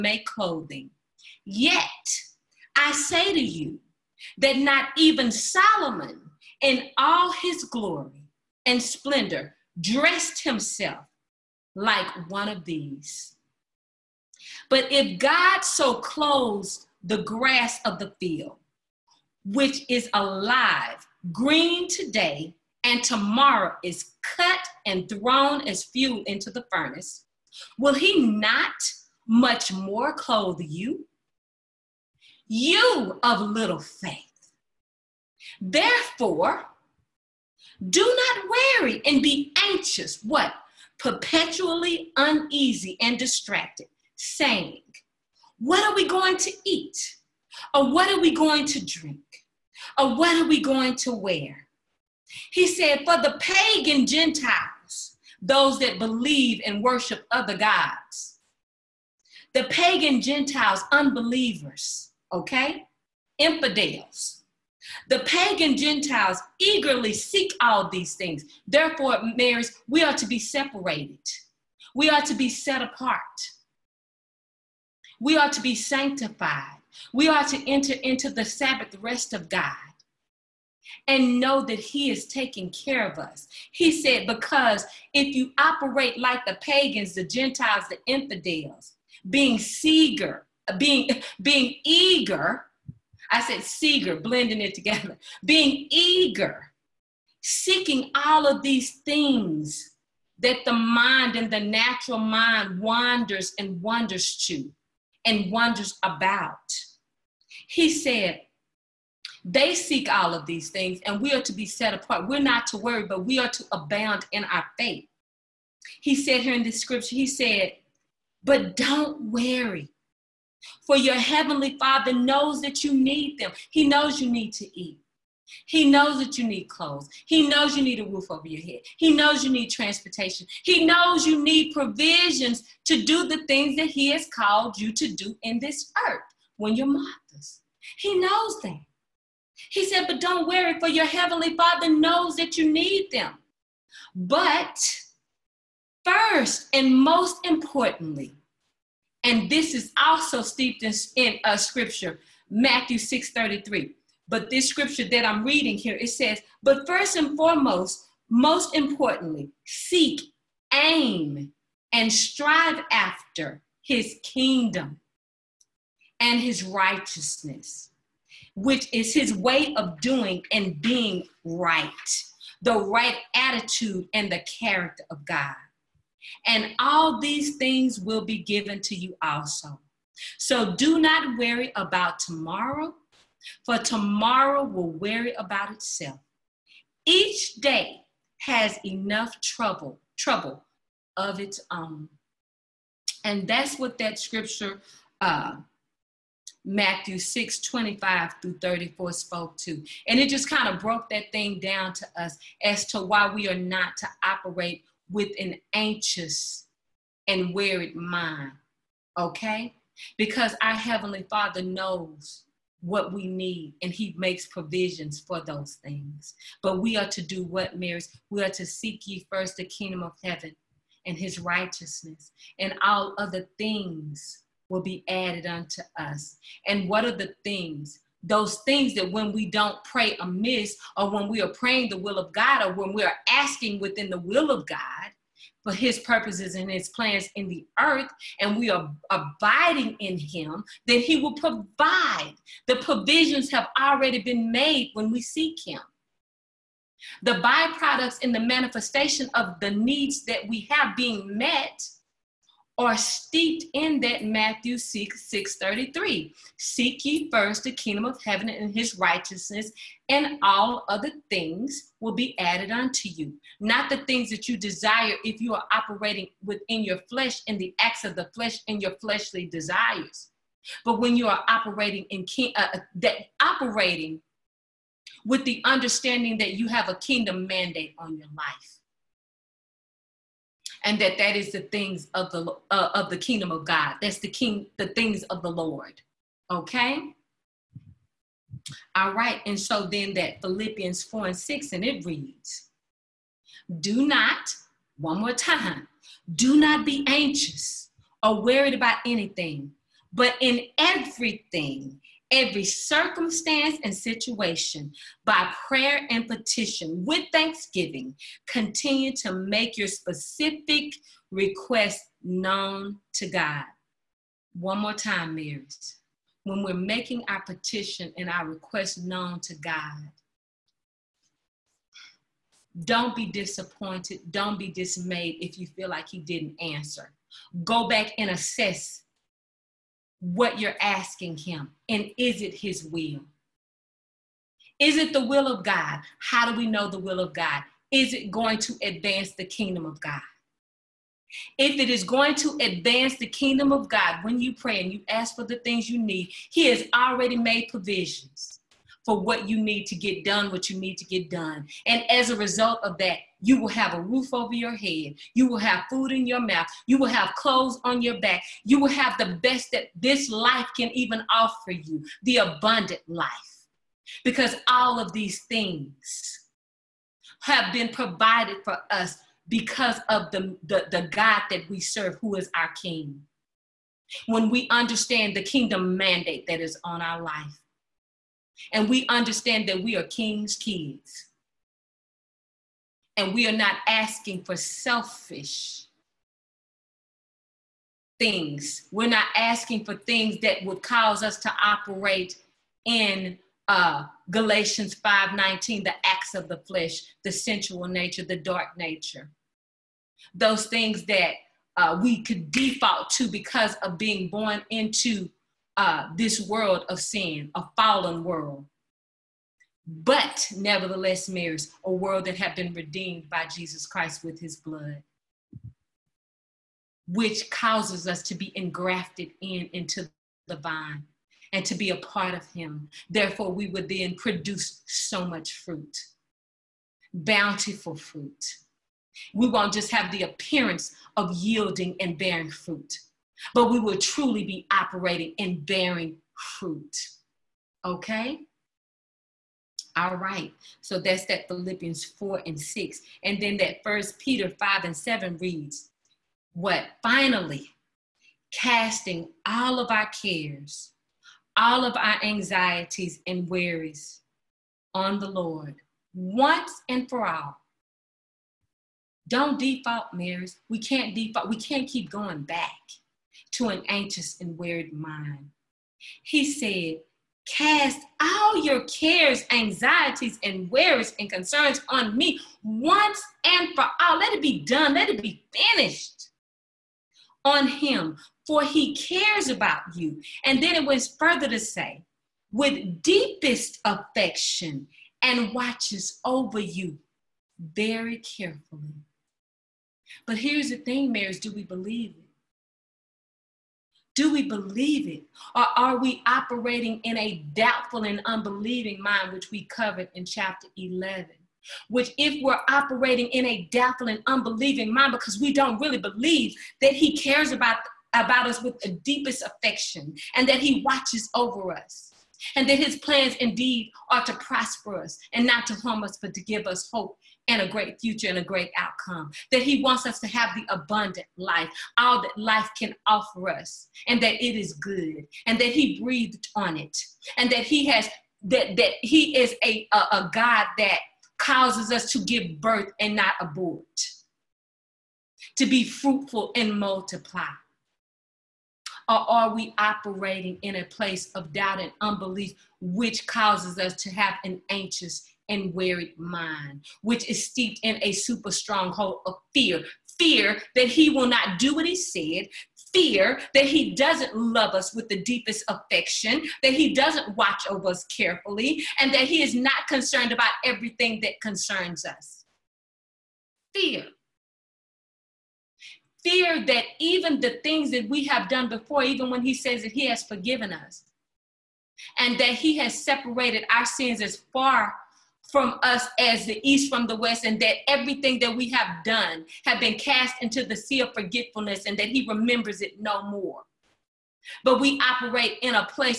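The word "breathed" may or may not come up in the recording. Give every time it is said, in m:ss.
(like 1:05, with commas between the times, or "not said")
8:46.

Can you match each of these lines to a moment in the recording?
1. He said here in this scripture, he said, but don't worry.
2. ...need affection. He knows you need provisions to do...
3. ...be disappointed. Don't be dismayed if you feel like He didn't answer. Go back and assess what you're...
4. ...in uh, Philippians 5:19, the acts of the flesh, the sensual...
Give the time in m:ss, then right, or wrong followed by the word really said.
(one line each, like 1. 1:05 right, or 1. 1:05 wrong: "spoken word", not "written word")
1. 1:56 right
2. 2:09 wrong: "transportation", not "affection"
3. 5:23 right
4. 6:32 wrong: "Galatians", not "Philippians".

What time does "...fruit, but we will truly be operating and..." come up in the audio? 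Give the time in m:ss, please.
7:12.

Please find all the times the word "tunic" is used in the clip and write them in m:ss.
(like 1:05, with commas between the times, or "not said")
not said.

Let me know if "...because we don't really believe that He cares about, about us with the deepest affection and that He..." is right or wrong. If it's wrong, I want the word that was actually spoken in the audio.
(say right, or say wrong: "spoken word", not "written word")
right.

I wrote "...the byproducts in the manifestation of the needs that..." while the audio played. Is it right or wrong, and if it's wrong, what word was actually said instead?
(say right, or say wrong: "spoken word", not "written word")
right.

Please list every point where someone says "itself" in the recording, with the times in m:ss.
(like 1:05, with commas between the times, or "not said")
3:05.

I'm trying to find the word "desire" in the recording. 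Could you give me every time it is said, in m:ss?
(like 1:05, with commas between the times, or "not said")
4:24, 4:29.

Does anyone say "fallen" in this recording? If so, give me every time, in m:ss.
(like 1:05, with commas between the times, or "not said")
6:47.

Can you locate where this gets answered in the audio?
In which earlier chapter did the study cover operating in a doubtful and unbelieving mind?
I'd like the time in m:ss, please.
8:20.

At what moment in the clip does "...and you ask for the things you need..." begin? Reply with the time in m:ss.
5:44.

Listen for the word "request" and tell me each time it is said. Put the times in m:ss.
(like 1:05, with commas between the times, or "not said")
5:11, 5:18.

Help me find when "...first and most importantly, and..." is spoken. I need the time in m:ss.
2:26.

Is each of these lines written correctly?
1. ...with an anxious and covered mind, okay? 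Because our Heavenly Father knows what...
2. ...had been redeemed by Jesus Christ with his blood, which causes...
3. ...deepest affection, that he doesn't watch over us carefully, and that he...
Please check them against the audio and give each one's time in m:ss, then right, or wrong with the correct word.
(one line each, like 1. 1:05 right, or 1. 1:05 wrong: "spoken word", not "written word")
1. 3:25 wrong: "worried", not "covered"
2. 6:52 right
3. 9:15 right.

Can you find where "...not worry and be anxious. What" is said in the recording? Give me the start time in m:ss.
0:38.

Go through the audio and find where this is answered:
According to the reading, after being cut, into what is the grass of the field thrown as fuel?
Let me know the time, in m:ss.
0:26.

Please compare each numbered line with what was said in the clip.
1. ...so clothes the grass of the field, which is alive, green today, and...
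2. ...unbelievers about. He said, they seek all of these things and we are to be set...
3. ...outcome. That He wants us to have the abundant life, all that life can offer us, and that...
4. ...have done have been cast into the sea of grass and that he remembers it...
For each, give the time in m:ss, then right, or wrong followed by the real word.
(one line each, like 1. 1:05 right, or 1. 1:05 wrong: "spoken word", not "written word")
1. 0:15 right
2. 1:45 wrong: "wonders", not "unbelievers"
3. 8:38 right
4. 9:38 wrong: "forgetfulness", not "grass".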